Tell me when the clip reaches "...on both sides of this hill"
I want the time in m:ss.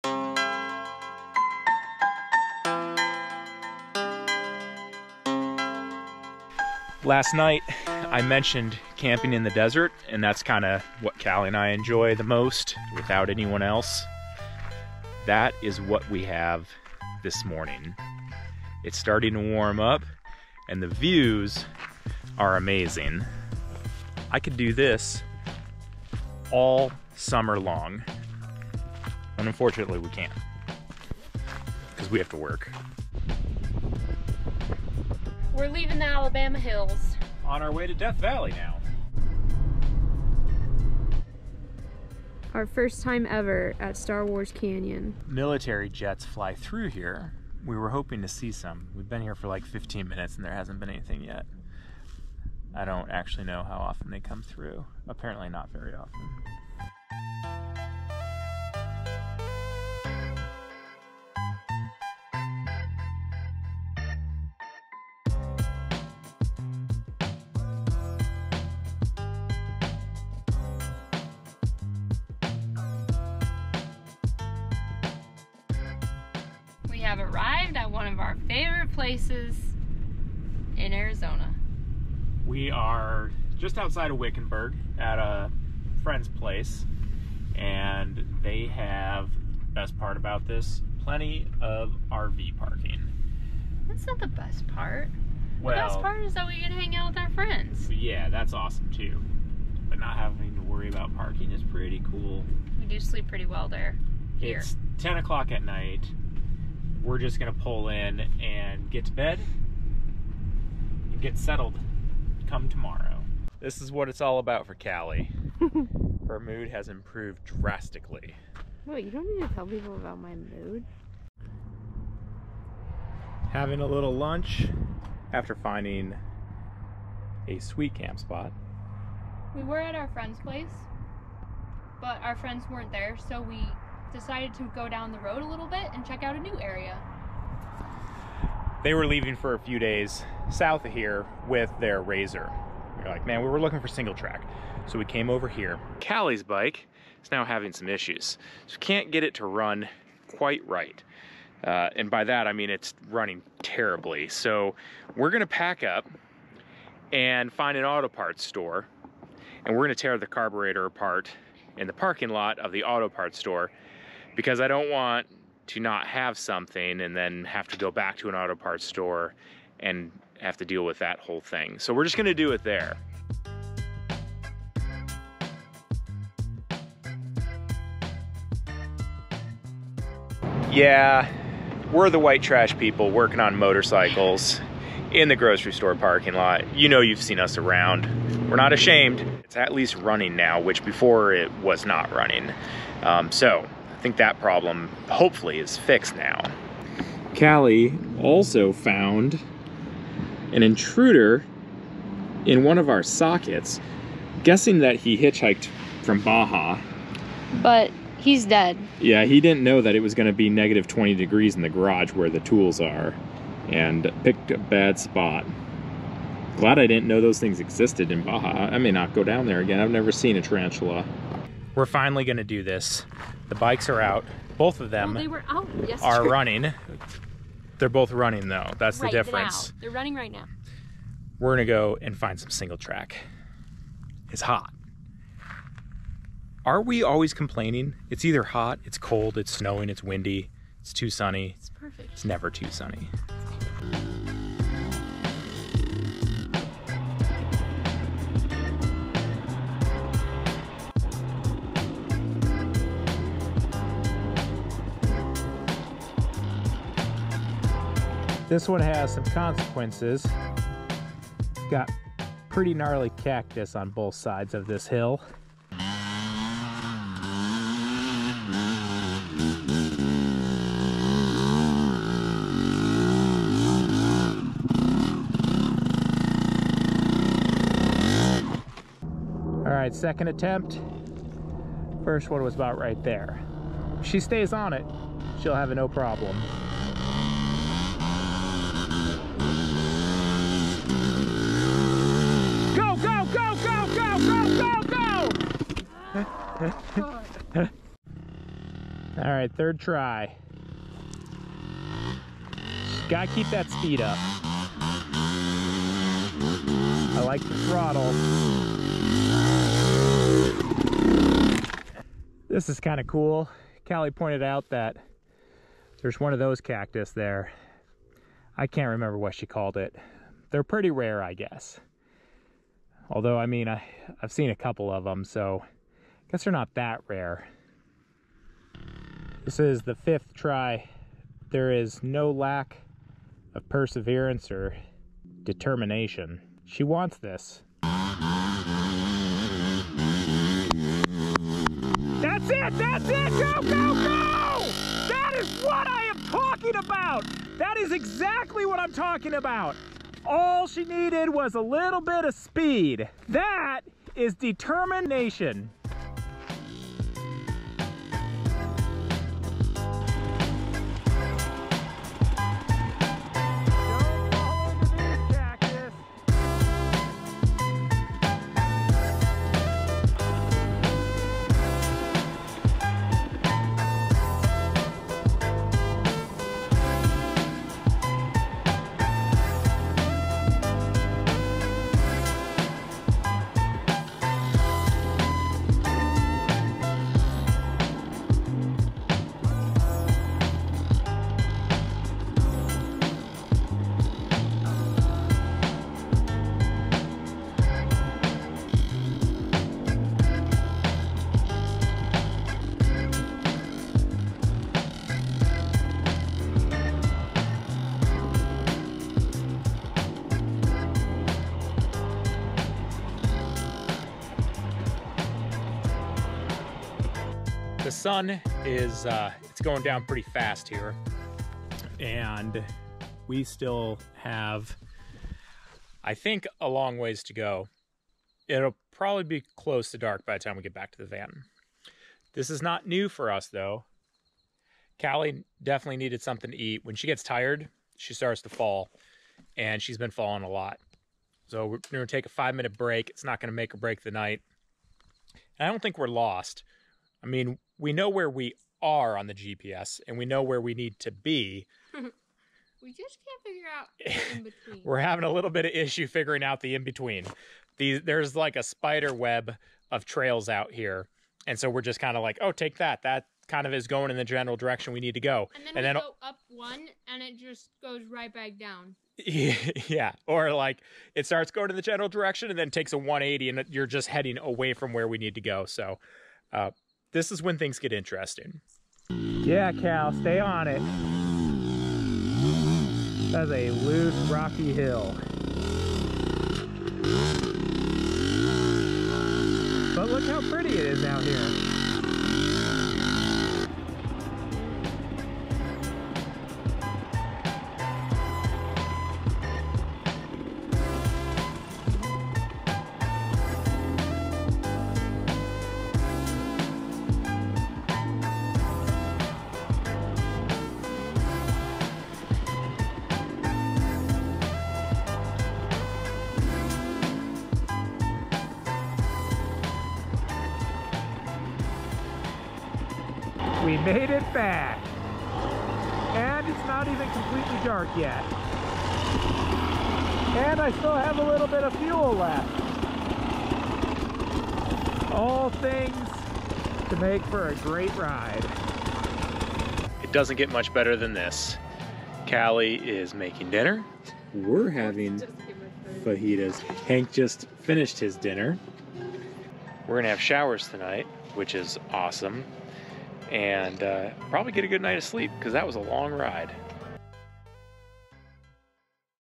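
4:23.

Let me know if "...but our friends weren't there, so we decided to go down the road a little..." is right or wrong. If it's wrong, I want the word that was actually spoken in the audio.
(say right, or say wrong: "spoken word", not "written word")
right.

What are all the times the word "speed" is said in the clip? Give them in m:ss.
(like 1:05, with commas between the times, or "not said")
5:03, 5:52.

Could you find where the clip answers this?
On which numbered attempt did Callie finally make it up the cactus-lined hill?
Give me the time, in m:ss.
5:29.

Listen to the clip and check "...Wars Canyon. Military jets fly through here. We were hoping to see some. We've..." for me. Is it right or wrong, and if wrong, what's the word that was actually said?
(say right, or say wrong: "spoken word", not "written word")
right.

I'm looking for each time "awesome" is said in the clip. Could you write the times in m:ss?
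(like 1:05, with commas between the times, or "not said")
1:38, 9:11.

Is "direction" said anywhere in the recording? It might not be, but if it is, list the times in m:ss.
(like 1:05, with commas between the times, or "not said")
7:44, 7:52.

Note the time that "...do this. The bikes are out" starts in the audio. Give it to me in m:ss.
3:42.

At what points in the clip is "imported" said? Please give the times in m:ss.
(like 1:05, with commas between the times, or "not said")
not said.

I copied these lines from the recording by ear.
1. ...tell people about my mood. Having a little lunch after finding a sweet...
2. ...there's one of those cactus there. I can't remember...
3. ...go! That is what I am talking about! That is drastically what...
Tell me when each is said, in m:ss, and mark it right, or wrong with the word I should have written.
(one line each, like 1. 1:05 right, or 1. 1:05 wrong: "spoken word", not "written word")
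1. 1:59 right
2. 5:16 right
3. 5:43 wrong: "exactly", not "drastically".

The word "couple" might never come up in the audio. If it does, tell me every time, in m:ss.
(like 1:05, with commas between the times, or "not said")
5:24.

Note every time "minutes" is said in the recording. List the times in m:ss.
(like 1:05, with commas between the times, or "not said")
0:50, 7:22.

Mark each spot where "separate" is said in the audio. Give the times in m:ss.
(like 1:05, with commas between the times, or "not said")
not said.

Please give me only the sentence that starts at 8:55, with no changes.
All things to make for a great ride.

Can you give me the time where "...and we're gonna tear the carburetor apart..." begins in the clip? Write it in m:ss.
2:39.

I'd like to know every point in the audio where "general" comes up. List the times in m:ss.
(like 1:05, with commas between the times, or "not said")
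7:44, 7:51.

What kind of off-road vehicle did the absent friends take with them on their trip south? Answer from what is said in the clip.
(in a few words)
Razor.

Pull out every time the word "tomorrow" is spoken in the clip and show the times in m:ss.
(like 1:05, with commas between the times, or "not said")
1:52.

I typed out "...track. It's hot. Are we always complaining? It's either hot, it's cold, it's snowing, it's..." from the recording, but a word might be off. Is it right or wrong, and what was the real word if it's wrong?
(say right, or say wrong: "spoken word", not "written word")
right.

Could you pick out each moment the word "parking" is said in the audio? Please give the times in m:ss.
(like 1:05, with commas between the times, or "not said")
1:32, 1:41, 2:41, 3:05.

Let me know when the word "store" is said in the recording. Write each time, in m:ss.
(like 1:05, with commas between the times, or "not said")
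2:38, 2:43, 2:48, 3:05.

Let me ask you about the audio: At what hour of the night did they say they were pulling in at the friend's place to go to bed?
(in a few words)
10 o'clock.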